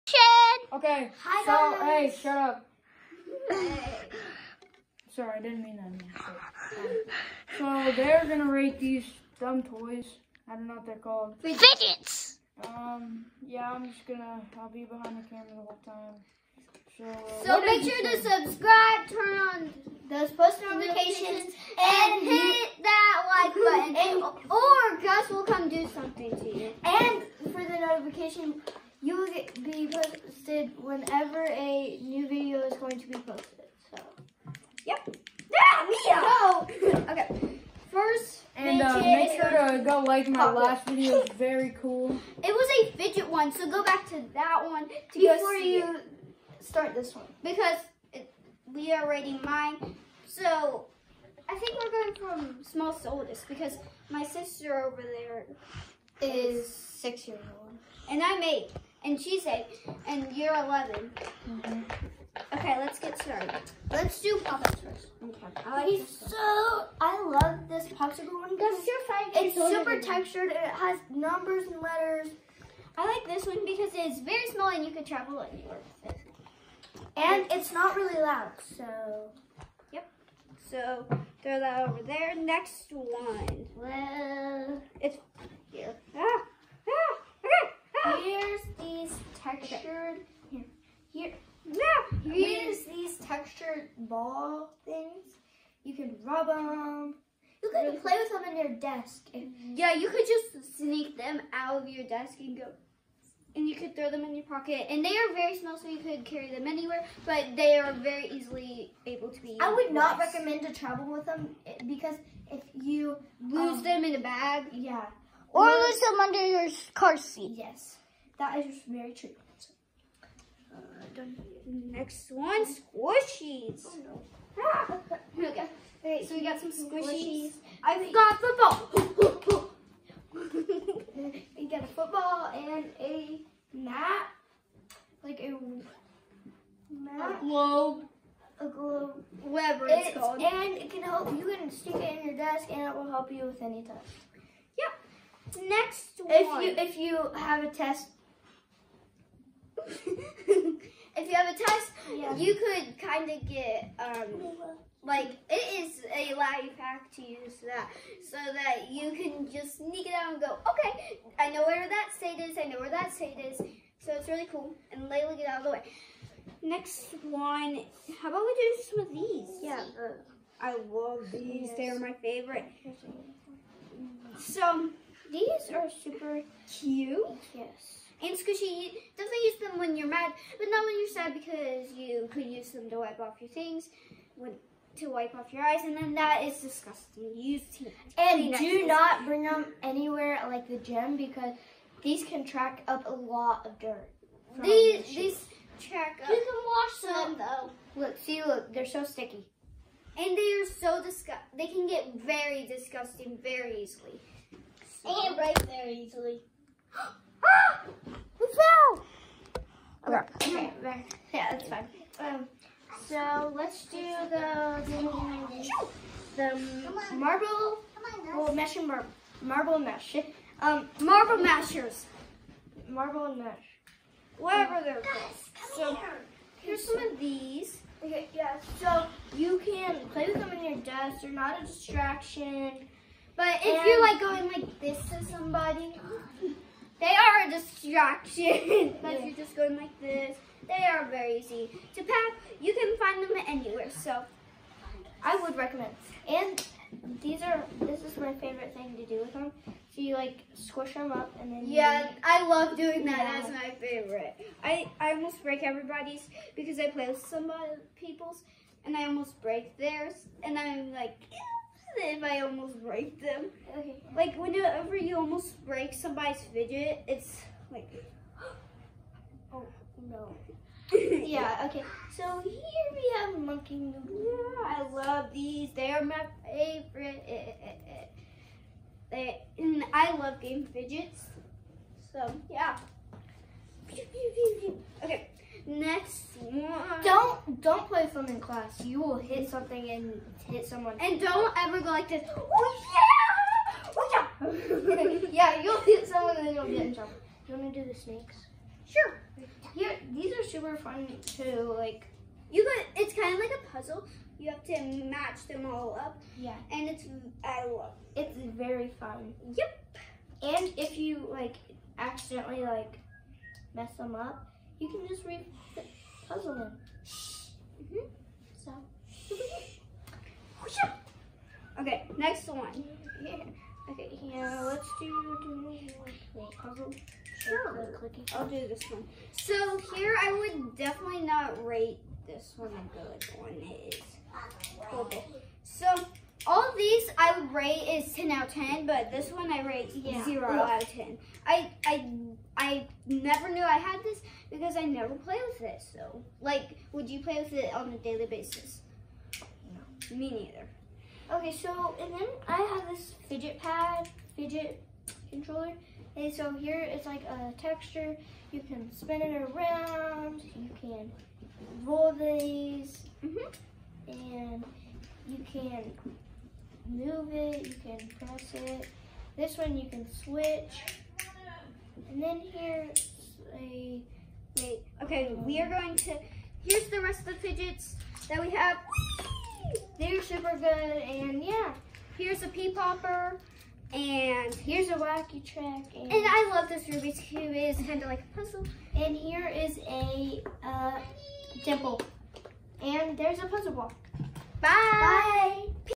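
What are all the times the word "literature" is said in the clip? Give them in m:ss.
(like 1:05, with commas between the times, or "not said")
not said.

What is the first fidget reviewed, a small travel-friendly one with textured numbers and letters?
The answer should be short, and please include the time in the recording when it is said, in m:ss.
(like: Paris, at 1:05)
popsicle one, at 1:07.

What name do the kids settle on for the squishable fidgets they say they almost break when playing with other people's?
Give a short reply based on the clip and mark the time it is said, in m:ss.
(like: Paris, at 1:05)
marble mesh, at 3:39.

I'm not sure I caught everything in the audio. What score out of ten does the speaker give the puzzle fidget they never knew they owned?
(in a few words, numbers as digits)
0.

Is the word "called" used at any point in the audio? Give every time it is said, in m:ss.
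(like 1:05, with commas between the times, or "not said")
0:10, 2:20, 3:45.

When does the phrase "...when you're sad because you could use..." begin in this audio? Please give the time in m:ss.
3:00.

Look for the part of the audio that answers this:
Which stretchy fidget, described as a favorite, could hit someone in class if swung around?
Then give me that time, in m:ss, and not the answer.
4:33.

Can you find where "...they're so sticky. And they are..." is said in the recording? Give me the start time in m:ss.
3:18.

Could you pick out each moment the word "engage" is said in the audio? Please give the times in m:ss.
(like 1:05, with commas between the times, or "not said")
not said.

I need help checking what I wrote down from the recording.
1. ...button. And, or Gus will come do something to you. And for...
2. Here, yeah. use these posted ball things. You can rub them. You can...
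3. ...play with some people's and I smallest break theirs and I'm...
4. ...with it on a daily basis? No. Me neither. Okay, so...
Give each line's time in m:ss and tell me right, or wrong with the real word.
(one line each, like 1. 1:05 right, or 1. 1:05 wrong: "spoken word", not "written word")
1. 0:23 right
2. 1:31 wrong: "textured", not "posted"
3. 4:16 wrong: "almost", not "smallest"
4. 5:47 right.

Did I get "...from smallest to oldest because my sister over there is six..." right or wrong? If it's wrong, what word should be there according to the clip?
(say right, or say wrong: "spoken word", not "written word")
right.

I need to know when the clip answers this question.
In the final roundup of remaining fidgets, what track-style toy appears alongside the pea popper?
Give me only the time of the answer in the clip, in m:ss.
6:24.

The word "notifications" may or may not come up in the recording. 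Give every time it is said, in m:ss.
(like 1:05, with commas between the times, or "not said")
0:20, 0:27.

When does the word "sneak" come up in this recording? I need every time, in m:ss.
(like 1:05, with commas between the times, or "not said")
1:40, 2:39.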